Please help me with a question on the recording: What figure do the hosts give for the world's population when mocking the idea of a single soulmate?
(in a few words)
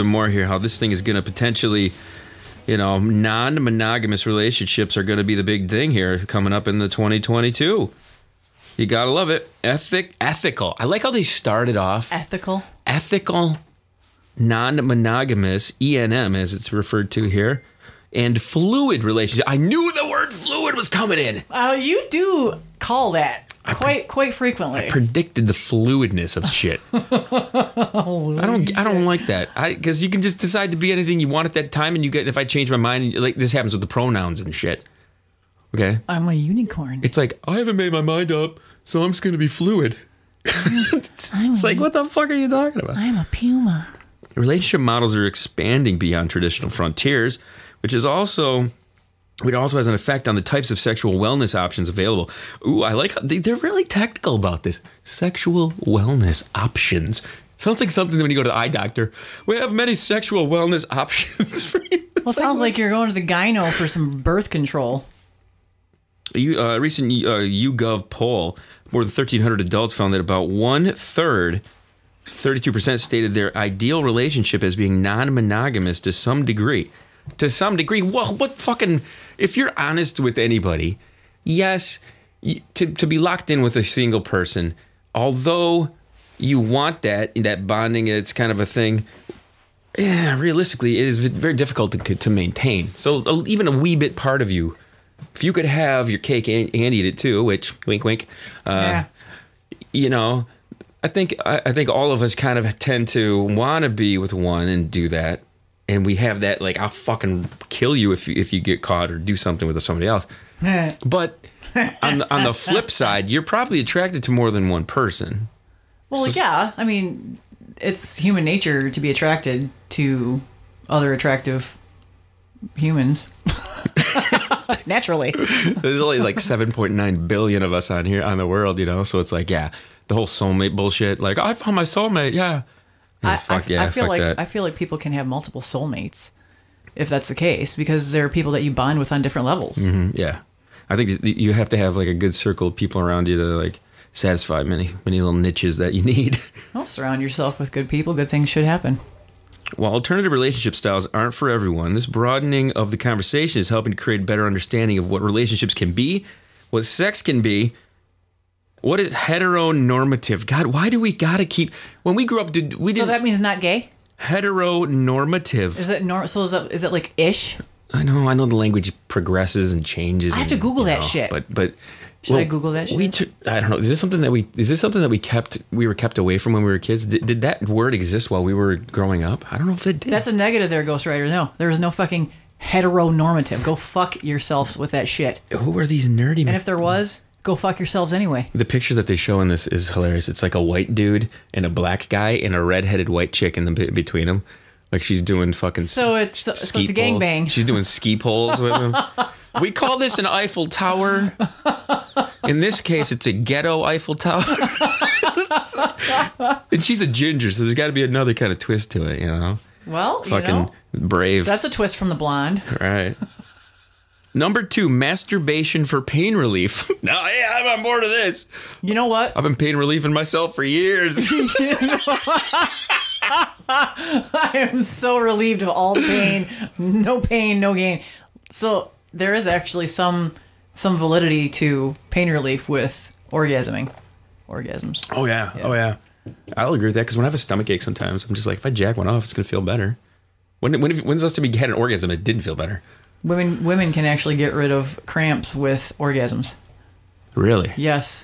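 7.9 billion.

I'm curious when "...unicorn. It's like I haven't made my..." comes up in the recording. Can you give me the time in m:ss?
0:36.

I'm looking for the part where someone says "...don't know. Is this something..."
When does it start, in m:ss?
2:53.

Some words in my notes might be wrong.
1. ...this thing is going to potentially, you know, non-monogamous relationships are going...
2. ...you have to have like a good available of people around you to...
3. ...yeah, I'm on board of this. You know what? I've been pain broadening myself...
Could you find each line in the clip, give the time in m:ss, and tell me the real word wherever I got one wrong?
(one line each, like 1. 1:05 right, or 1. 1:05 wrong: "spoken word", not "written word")
1. 0:00 right
2. 2:21 wrong: "circle", not "available"
3. 3:37 wrong: "relieving", not "broadening".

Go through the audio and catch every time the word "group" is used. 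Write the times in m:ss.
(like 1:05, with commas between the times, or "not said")
not said.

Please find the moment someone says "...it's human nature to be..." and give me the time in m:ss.
1:57.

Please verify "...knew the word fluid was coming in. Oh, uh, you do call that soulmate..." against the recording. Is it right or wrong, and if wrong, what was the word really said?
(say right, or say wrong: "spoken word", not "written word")
wrong: "quite", not "soulmate".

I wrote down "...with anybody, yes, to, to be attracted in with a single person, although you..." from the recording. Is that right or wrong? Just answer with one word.
wrong.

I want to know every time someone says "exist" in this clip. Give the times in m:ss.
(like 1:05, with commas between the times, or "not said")
2:57.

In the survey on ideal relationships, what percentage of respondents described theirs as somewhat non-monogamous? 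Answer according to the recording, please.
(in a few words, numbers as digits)
32%.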